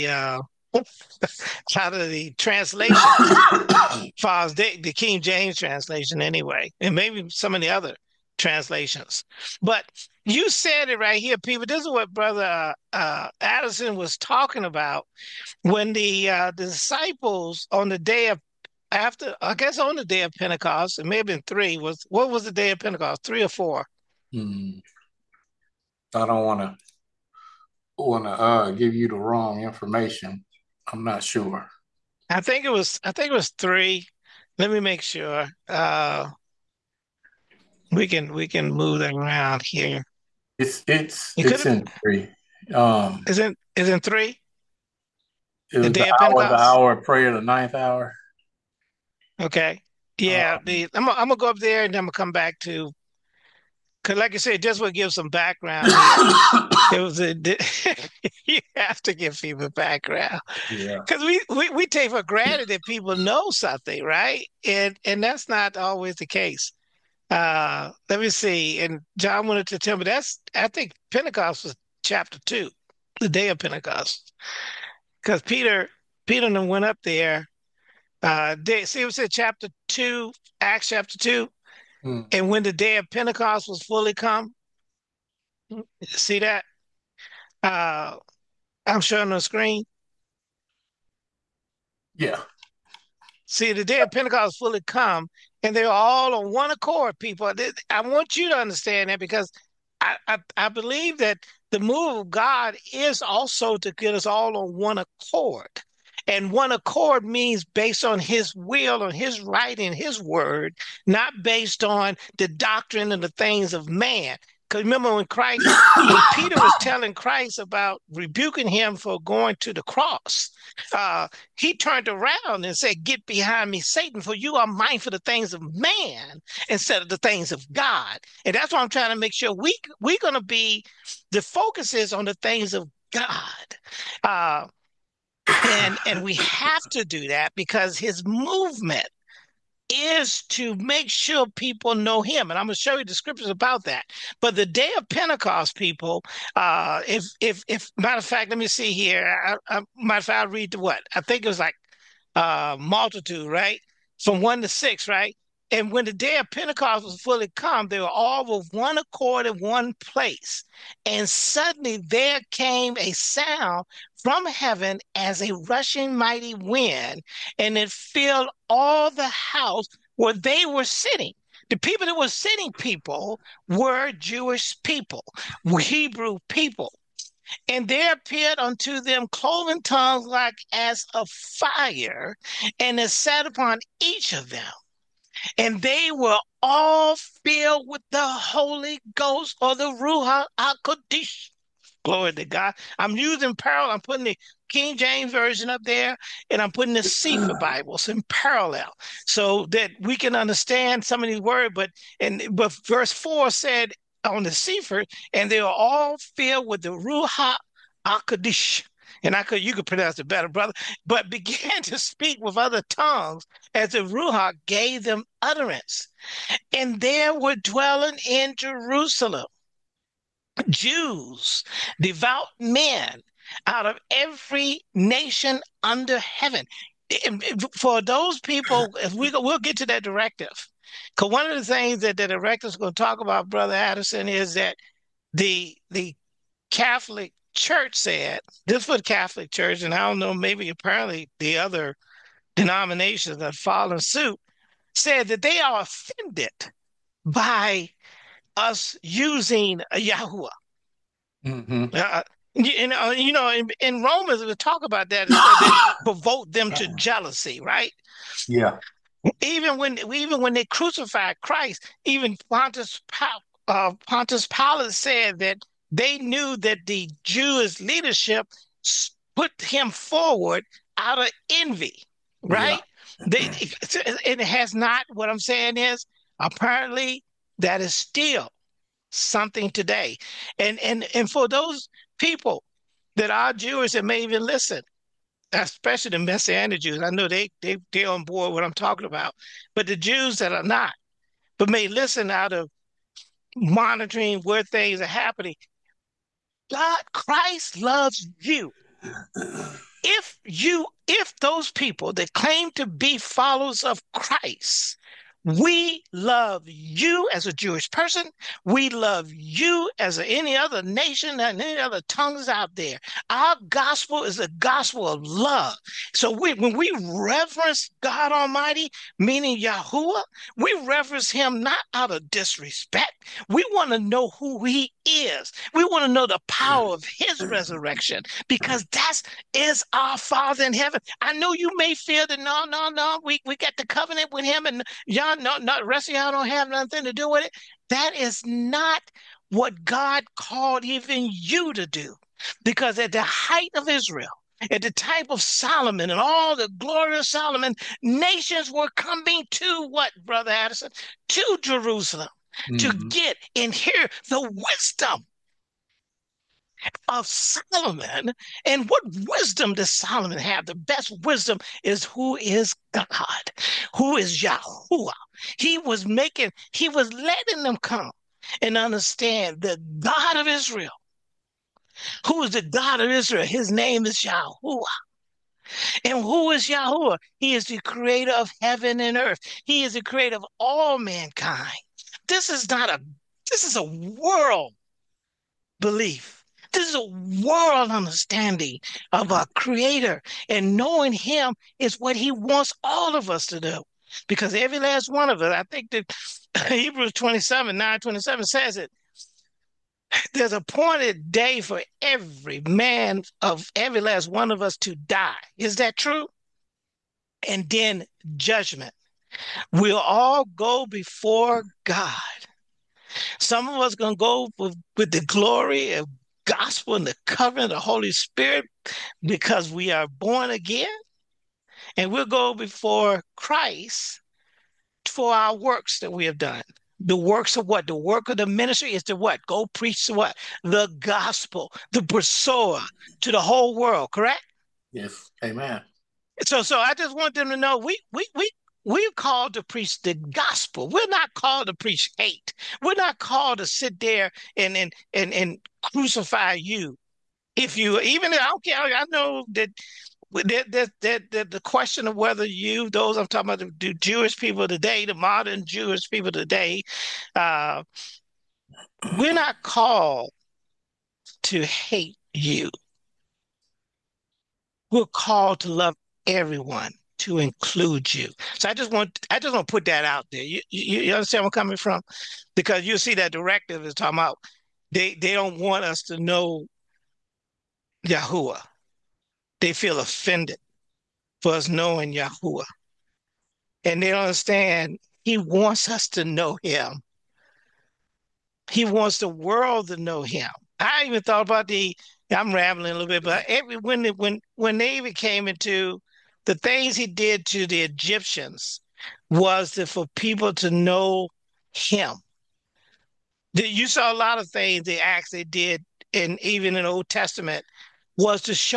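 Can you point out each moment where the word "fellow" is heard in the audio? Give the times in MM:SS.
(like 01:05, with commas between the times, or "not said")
not said.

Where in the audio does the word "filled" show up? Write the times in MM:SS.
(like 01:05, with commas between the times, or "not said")
02:47, 03:07, 03:26.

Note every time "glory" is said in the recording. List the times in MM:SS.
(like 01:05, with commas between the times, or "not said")
03:12, 05:46, 06:55.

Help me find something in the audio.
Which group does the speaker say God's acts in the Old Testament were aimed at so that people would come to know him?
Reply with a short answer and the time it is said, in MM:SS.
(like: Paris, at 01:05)
the Egyptians, at 08:17.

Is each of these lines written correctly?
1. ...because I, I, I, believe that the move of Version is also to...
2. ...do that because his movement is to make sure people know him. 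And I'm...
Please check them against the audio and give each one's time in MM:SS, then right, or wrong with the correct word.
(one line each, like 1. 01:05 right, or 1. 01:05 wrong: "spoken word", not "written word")
1. 01:39 wrong: "God", not "Version"
2. 02:17 right.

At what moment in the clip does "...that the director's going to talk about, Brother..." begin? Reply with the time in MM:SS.
03:51.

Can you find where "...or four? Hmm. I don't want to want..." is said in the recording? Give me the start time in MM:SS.
00:23.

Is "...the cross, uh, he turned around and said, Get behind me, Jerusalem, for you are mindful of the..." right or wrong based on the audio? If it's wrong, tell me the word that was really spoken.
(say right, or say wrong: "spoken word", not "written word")
wrong: "Satan", not "Jerusalem".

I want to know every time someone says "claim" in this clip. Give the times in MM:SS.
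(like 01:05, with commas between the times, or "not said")
05:02.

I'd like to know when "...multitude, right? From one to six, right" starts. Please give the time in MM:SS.
02:32.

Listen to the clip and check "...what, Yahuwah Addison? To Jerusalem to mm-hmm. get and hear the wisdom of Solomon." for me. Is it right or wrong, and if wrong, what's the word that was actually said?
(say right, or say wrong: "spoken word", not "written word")
wrong: "Brother", not "Yahuwah".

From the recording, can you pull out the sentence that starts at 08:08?
He wants the world to know him.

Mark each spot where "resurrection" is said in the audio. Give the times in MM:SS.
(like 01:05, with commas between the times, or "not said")
05:27.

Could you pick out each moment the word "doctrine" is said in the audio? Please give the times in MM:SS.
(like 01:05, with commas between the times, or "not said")
01:52.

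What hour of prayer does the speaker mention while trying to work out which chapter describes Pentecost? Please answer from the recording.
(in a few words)
the ninth hour.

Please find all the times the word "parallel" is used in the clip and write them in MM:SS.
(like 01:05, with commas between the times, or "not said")
03:13, 03:18.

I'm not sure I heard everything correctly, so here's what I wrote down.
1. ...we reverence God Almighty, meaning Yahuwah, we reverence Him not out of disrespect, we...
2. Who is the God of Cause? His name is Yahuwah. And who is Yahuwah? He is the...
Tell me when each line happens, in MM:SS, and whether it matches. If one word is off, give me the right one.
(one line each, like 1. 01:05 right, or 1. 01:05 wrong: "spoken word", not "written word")
1. 05:16 right
2. 06:12 wrong: "Israel", not "Cause".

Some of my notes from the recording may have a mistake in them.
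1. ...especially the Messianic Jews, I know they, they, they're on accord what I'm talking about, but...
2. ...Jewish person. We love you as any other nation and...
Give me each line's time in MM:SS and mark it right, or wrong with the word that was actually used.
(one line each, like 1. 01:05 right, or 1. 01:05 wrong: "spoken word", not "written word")
1. 04:45 wrong: "board", not "accord"
2. 05:07 right.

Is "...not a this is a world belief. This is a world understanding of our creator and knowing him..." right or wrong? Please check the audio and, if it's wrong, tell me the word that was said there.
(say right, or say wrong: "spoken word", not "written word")
right.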